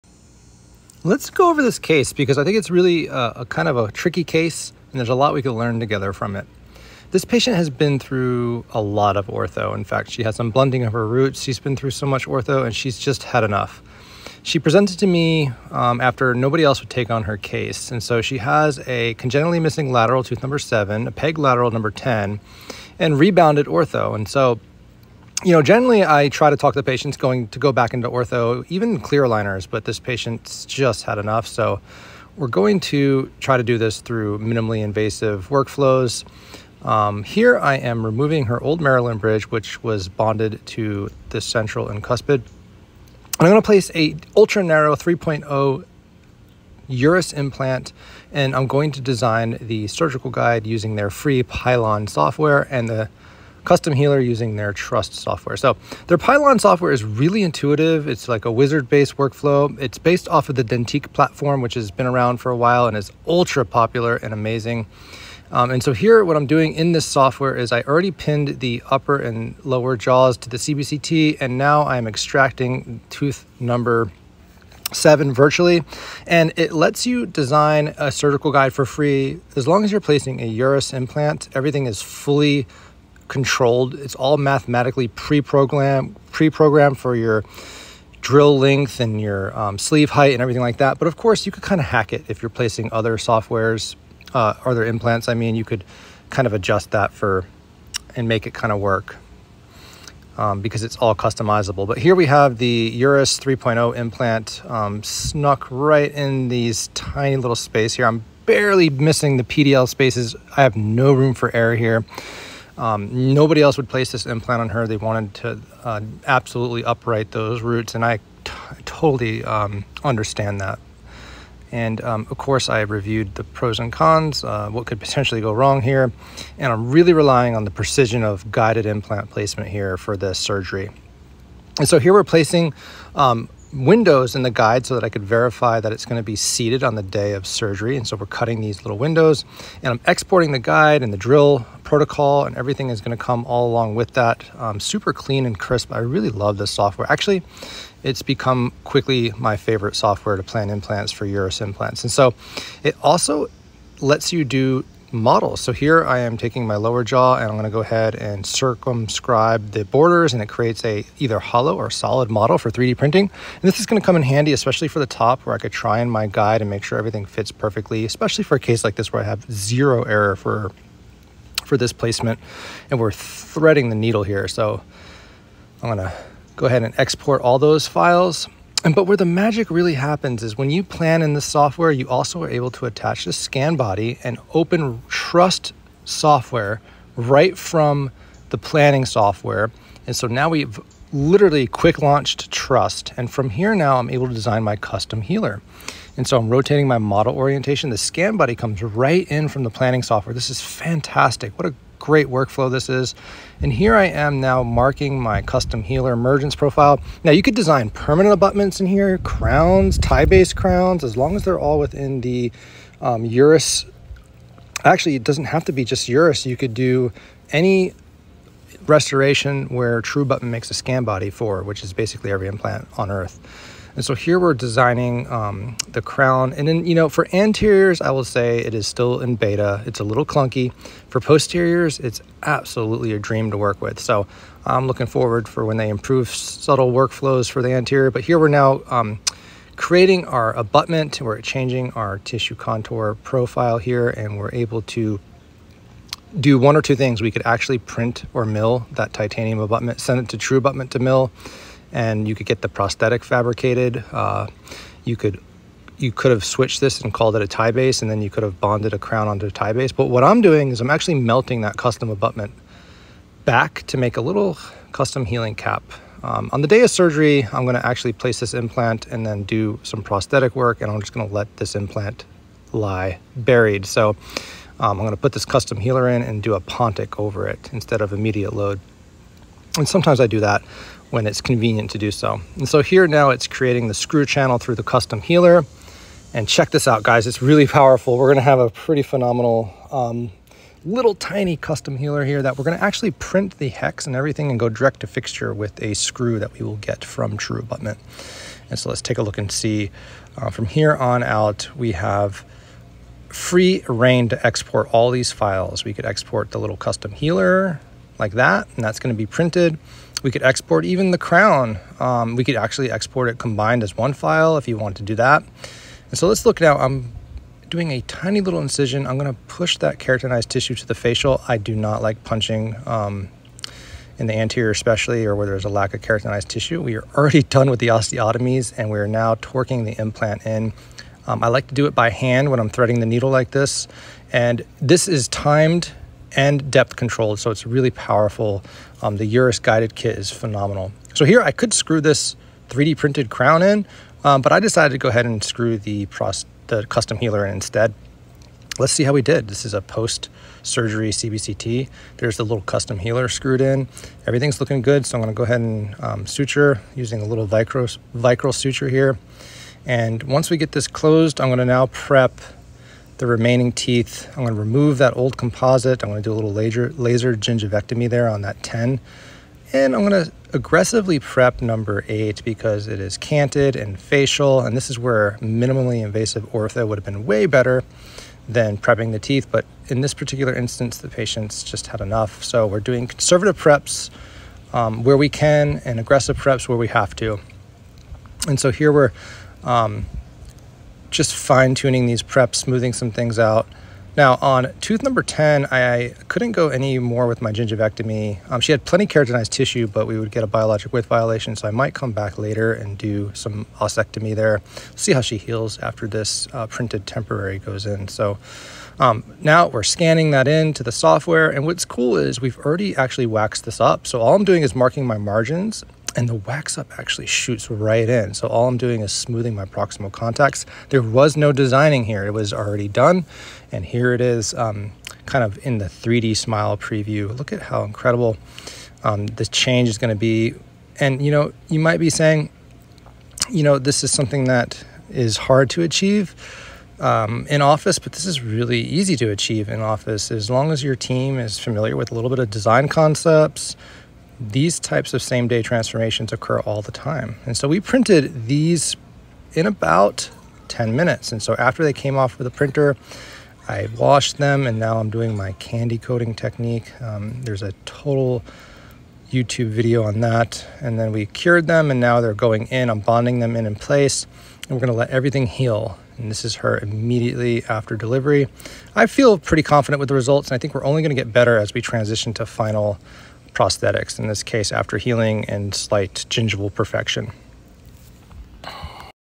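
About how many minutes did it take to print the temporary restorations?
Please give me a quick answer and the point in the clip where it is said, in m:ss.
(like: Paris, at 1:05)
10, at 7:30.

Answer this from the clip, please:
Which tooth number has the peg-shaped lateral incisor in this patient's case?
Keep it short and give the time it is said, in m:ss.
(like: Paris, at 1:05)
10, at 0:21.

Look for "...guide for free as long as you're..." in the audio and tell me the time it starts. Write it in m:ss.
1:18.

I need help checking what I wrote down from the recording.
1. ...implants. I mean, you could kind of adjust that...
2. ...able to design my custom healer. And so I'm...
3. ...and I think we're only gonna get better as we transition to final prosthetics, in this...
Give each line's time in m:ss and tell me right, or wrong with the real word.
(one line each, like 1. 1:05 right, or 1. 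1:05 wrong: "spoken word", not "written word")
1. 1:34 right
2. 3:14 right
3. 7:50 right.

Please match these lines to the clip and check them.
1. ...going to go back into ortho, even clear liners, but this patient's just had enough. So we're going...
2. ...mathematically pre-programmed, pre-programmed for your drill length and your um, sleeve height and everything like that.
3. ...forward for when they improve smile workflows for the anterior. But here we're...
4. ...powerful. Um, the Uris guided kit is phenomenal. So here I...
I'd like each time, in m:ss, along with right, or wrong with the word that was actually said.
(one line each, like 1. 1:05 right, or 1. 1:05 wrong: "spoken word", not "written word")
1. 0:27 right
2. 1:24 right
3. 3:55 wrong: "subtle", not "smile"
4. 5:37 right.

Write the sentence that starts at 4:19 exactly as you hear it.
But what I'm doing is I'm actually melting that custom abutment back to make a little custom healing cap.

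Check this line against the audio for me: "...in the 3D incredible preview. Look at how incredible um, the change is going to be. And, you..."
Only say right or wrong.
wrong.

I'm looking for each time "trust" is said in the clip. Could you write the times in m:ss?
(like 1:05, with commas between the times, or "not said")
0:54, 3:05, 3:12.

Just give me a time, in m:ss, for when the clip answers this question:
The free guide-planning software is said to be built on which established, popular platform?
1:00.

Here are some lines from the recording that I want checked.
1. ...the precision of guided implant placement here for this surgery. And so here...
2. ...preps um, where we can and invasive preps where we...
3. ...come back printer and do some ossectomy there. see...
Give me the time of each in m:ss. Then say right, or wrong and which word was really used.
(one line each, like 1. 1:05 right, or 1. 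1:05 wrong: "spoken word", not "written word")
1. 2:07 right
2. 6:23 wrong: "aggressive", not "invasive"
3. 6:41 wrong: "later", not "printer".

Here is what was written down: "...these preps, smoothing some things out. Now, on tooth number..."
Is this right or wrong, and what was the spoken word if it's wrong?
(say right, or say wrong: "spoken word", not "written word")
right.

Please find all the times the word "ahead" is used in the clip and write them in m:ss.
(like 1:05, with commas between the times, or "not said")
2:37, 2:56, 5:45, 5:55.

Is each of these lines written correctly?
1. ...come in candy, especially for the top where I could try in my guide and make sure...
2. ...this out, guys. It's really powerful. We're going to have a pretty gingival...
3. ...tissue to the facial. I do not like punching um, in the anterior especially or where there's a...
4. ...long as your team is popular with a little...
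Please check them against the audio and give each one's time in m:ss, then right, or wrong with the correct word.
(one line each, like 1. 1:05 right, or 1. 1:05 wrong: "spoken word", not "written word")
1. 2:44 wrong: "handy", not "candy"
2. 4:46 wrong: "phenomenal", not "gingival"
3. 5:20 right
4. 7:20 wrong: "familiar", not "popular".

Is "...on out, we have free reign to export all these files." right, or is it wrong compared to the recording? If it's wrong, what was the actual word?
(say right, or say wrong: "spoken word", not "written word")
right.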